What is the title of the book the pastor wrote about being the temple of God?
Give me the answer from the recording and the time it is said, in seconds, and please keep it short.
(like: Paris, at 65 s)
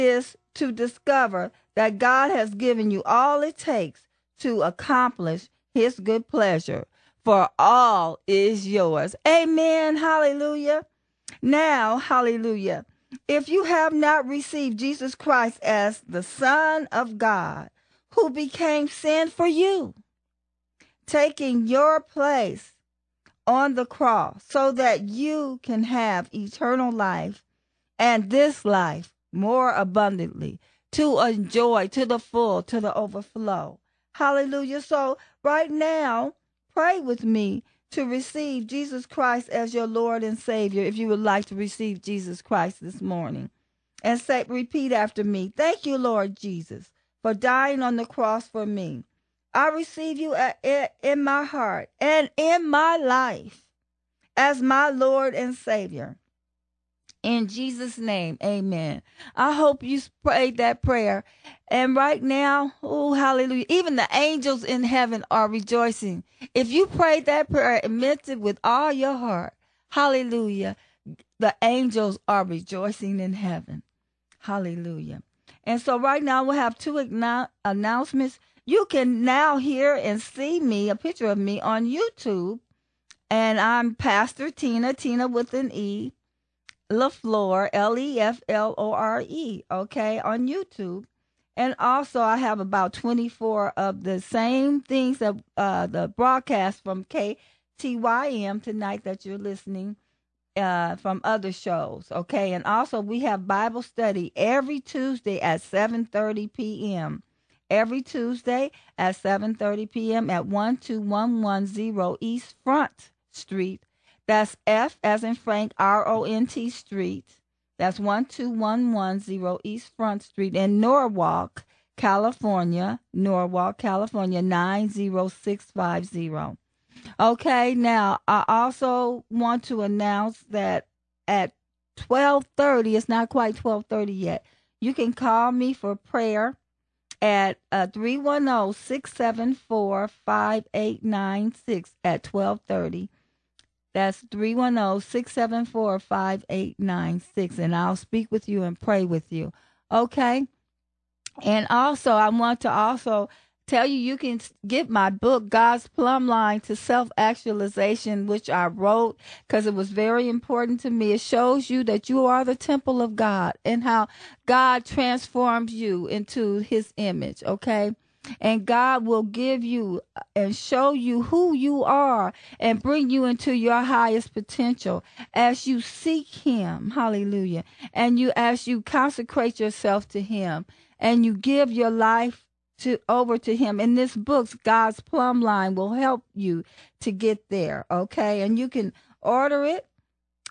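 God's Plumb Line to Self-Actualization, at 155 s.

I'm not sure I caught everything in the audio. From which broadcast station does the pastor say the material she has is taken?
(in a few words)
KTYM.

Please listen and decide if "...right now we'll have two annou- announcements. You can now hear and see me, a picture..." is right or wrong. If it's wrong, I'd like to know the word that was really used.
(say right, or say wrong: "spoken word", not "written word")
right.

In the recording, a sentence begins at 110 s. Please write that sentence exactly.
at 12110 East Front Street, that's F as in Frank, R O N T Street.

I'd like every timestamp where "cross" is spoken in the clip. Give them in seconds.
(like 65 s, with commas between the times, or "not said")
23 s, 48 s.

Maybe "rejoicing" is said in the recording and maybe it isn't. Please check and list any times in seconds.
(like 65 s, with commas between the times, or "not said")
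65 s, 72 s.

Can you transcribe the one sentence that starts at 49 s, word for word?
I receive you in my heart and in my life as my Lord and Savior.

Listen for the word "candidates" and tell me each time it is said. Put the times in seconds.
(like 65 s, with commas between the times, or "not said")
not said.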